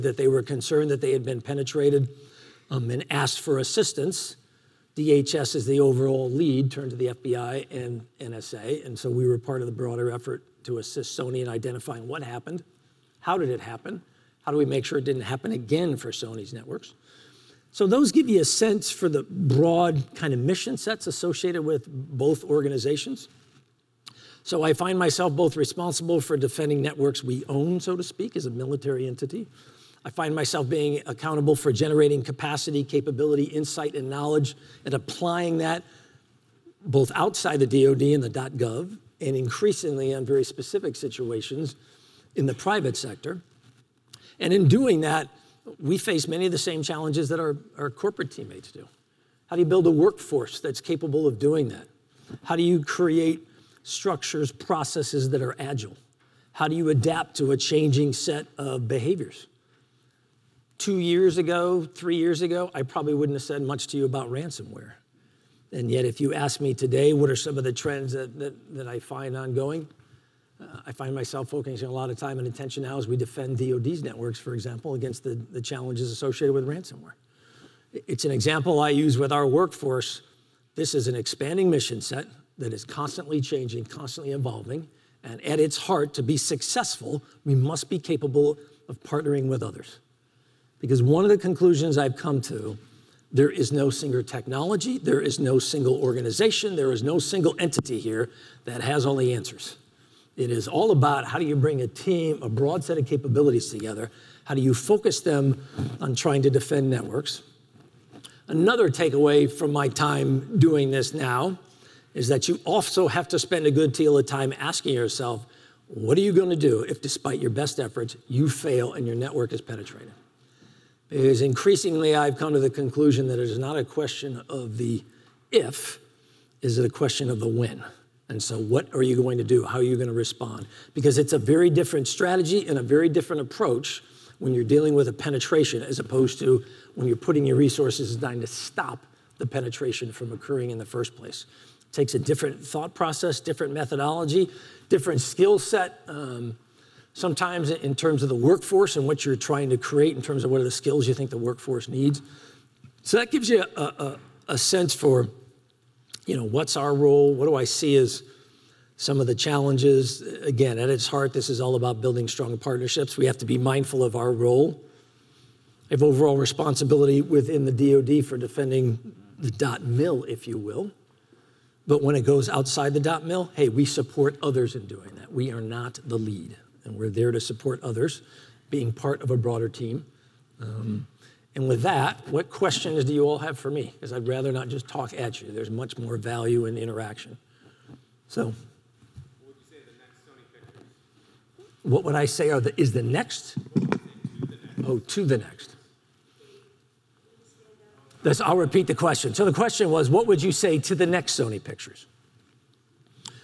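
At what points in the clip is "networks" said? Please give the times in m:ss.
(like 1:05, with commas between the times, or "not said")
0:16, 0:26, 1:14, 1:46, 1:59.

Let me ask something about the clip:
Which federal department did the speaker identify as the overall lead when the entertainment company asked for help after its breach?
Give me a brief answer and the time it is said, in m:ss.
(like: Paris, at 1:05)
DHS, at 0:04.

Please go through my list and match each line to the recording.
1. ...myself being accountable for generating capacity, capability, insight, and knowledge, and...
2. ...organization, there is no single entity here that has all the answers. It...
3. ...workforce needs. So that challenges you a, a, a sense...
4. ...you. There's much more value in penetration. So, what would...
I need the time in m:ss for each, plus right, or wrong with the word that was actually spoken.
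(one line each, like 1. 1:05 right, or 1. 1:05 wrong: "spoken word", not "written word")
1. 0:30 right
2. 1:36 right
3. 2:31 wrong: "gives", not "challenges"
4. 3:05 wrong: "interaction", not "penetration".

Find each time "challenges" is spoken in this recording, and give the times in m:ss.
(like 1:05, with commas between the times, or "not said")
0:46, 1:15, 2:39.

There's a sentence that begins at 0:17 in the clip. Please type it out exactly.
So those give you a sense for the broad kind of mission sets associated with both organizations.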